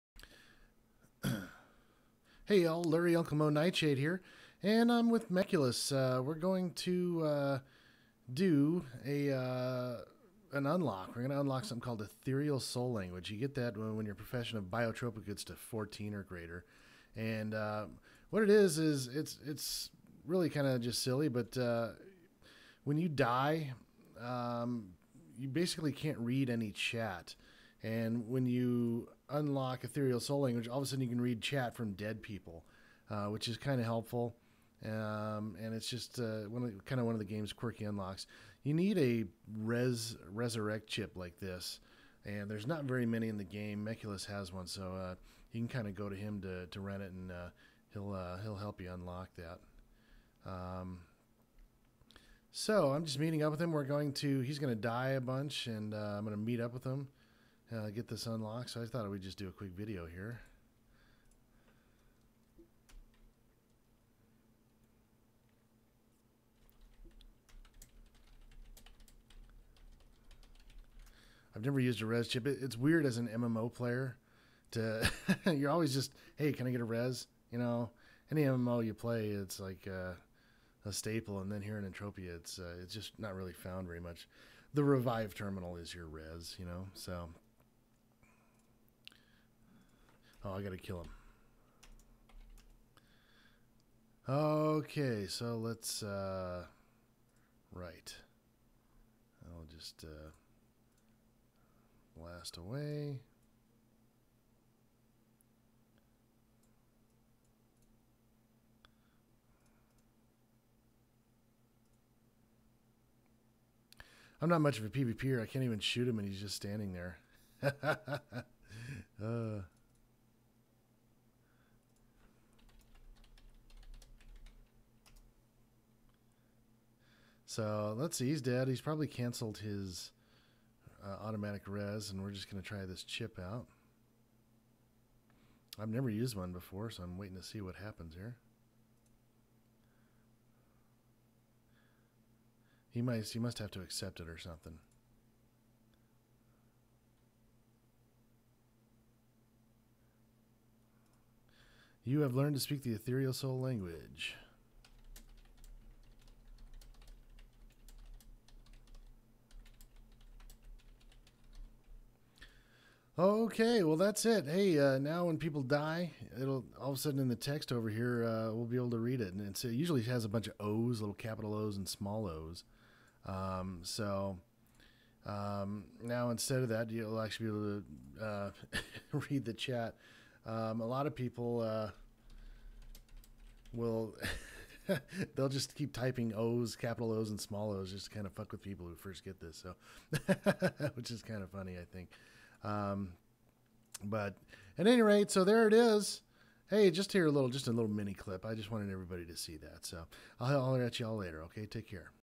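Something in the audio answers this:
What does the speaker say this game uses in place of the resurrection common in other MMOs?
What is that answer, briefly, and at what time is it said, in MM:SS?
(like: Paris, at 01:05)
The revive terminal, at 01:24.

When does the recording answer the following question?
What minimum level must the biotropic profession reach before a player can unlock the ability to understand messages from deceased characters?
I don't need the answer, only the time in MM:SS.
00:15.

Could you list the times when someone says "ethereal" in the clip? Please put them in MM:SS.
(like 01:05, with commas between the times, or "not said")
00:12, 00:29, 02:32.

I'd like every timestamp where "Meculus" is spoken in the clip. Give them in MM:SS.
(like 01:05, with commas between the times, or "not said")
00:05, 00:43.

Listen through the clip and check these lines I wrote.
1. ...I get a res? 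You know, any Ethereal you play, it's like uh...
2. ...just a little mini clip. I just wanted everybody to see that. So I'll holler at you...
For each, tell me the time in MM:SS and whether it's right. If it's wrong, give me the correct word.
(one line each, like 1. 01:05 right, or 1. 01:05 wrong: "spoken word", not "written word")
1. 01:16 wrong: "MMO", not "Ethereal"
2. 03:17 right.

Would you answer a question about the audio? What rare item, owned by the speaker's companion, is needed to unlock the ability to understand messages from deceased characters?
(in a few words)
resurrect chip.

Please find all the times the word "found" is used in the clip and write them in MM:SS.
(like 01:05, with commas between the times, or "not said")
01:23.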